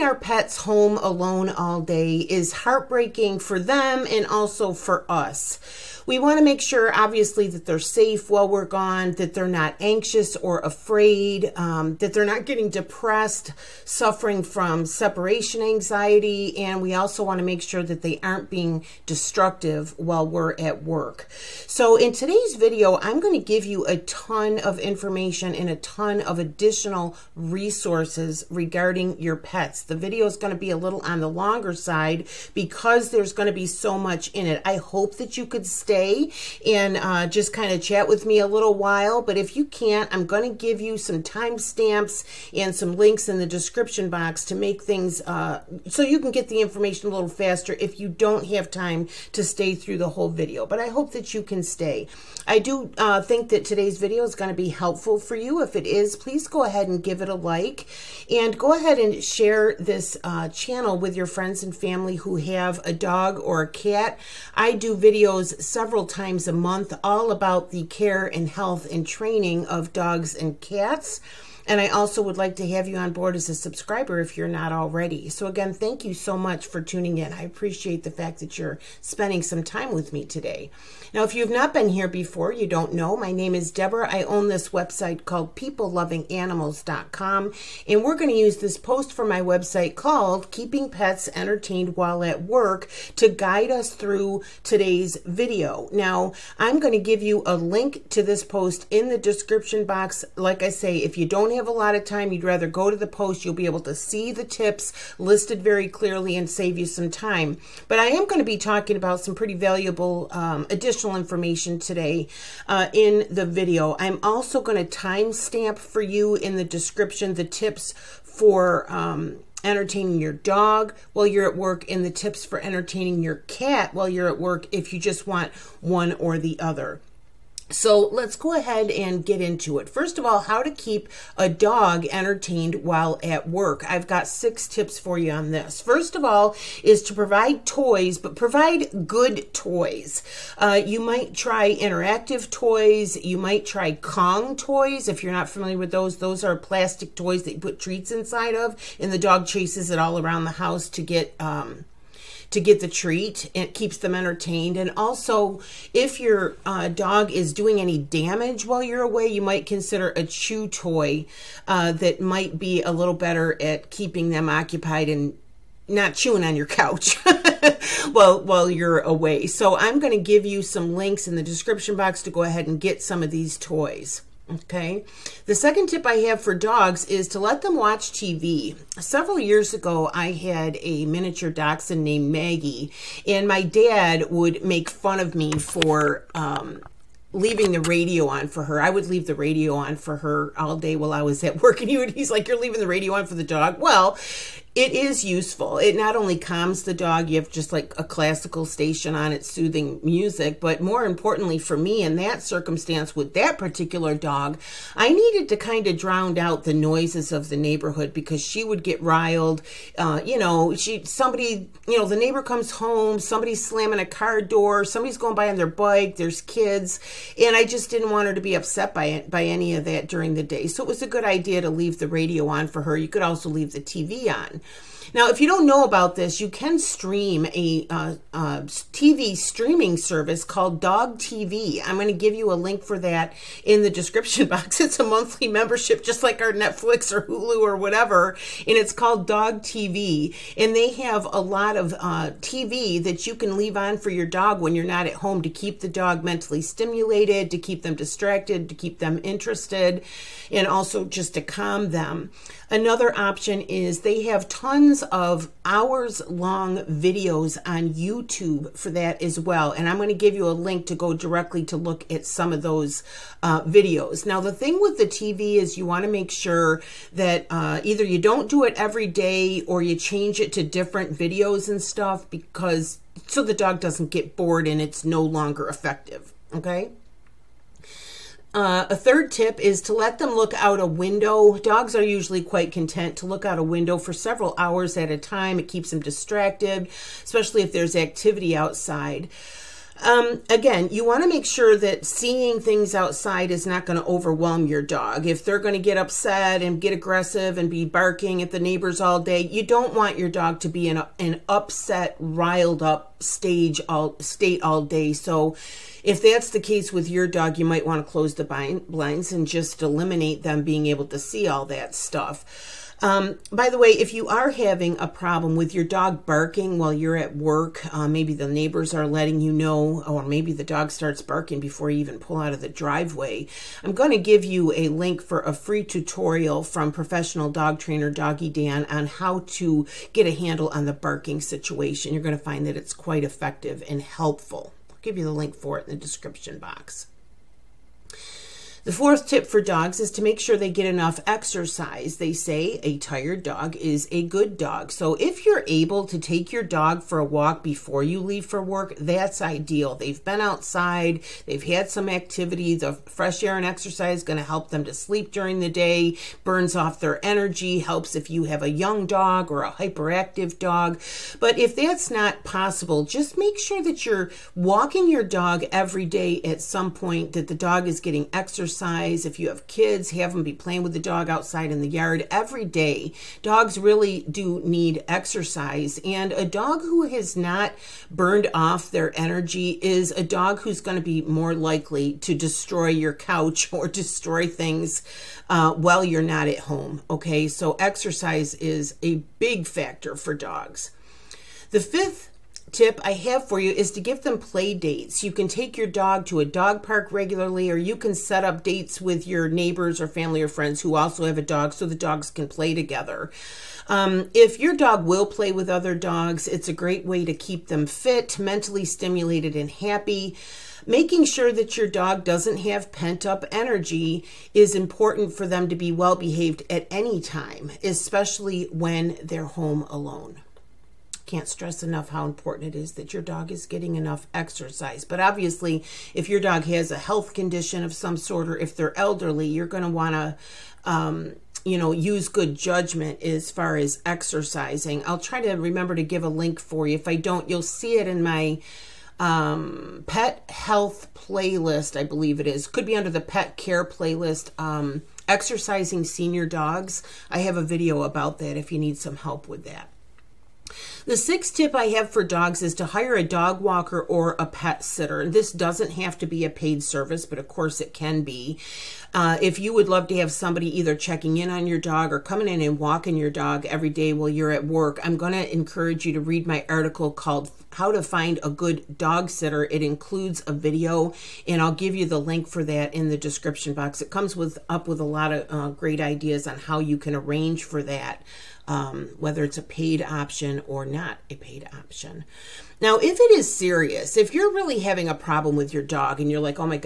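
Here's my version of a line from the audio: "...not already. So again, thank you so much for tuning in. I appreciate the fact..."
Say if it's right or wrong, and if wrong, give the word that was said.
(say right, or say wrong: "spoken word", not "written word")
right.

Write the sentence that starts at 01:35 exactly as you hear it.
Now, I'm going to give you a link to this post in the description box.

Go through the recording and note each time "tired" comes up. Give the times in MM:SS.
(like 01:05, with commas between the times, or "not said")
05:42.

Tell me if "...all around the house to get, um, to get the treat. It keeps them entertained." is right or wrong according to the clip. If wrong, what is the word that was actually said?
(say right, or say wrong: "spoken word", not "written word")
right.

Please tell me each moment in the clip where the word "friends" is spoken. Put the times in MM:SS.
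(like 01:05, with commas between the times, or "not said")
01:01, 06:40.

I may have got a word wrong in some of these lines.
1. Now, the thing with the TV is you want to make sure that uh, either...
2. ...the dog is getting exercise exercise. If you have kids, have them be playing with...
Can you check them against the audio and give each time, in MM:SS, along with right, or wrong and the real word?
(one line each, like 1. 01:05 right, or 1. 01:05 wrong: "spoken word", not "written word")
1. 04:24 right
2. 06:07 right.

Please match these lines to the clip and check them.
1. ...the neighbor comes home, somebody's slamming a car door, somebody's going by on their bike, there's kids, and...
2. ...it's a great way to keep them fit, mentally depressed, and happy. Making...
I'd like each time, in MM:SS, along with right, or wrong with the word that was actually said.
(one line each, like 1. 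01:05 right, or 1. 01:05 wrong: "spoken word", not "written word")
1. 03:32 right
2. 06:46 wrong: "stimulated", not "depressed".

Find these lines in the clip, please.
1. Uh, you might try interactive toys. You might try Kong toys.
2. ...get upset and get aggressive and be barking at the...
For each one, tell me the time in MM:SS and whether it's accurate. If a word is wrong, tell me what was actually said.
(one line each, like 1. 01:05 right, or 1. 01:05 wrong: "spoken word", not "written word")
1. 02:20 right
2. 04:55 right.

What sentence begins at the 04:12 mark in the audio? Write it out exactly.
Another option is they have tons tons of hours long videos on YouTube for that as well.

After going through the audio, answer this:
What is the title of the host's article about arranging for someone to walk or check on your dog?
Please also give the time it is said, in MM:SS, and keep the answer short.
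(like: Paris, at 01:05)
How to Find a Good Dog Sitter, at 07:47.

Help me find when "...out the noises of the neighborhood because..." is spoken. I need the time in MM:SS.
03:26.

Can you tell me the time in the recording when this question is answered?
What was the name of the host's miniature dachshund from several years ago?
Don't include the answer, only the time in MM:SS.
03:02.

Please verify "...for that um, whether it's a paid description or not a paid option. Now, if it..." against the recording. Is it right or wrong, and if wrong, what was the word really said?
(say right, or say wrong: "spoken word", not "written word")
wrong: "option", not "description".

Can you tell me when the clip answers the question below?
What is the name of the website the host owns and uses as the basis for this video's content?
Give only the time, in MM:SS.
01:25.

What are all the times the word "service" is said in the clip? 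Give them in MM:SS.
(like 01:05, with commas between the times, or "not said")
03:49, 07:36.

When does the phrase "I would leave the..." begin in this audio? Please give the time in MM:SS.
03:08.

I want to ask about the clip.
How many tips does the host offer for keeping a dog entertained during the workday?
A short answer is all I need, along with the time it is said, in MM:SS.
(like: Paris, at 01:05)
6, at 02:14.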